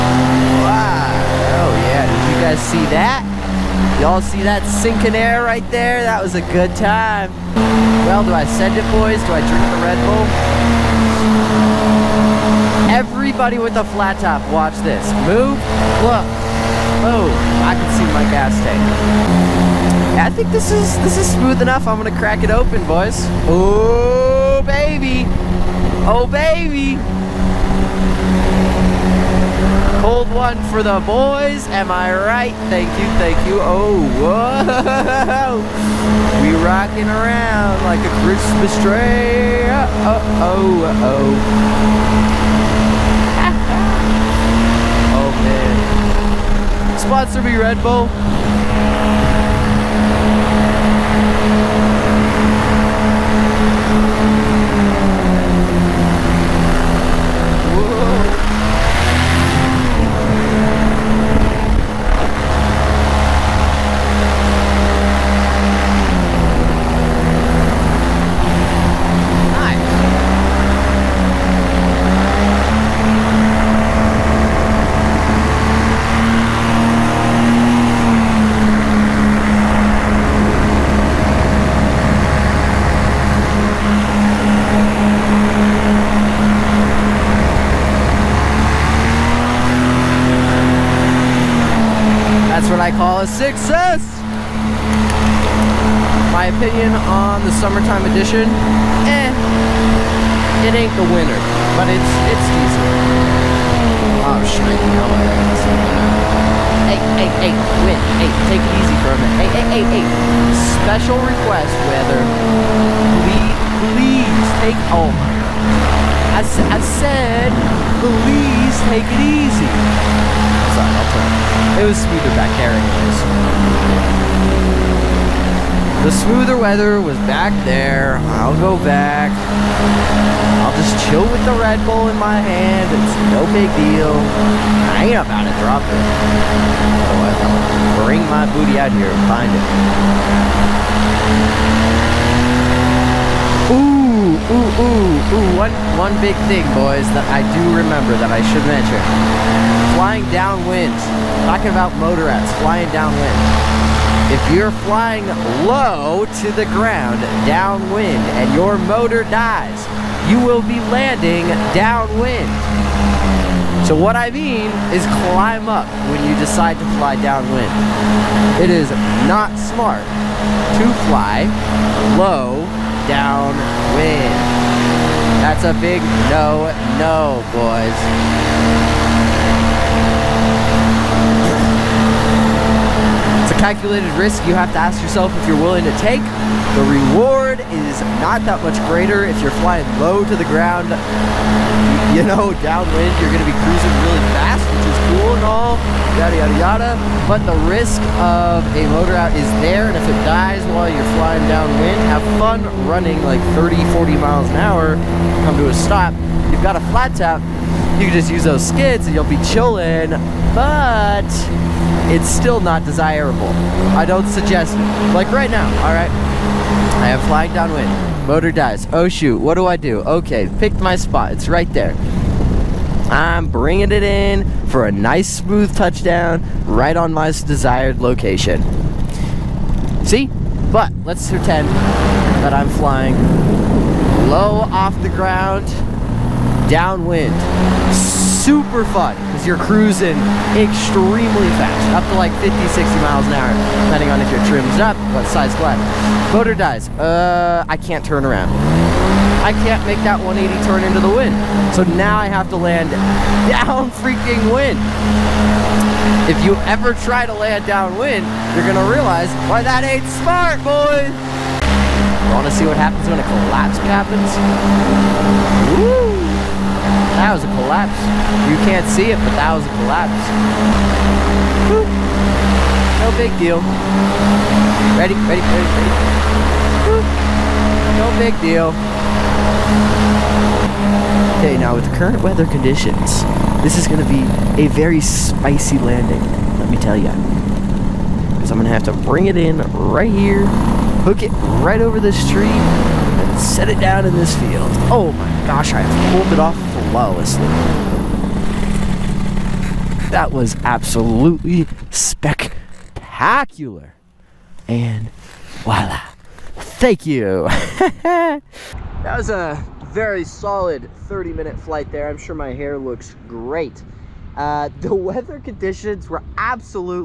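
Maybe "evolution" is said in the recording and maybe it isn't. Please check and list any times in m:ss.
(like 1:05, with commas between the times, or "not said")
not said.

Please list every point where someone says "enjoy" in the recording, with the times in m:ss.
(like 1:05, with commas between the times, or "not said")
not said.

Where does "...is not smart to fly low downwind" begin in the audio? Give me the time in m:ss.
2:48.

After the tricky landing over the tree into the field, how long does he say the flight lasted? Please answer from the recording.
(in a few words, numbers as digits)
30 minutes.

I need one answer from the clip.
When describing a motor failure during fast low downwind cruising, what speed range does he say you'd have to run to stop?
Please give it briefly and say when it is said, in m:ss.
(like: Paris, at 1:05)
30-40 mph, at 3:23.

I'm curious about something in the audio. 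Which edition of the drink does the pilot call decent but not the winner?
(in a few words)
Summertime edition.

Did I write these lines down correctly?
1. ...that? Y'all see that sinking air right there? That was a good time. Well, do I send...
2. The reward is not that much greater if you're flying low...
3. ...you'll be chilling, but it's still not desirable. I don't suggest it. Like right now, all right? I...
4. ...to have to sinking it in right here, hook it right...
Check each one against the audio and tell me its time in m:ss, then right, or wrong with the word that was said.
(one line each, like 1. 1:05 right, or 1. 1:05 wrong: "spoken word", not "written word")
1. 0:02 right
2. 3:06 right
3. 3:29 right
4. 4:48 wrong: "bring", not "sinking".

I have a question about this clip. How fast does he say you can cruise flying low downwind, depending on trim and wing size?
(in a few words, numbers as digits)
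50-60 mph.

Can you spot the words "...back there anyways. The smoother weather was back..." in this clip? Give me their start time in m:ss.
2:02.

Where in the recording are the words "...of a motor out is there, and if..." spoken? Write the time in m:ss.
3:18.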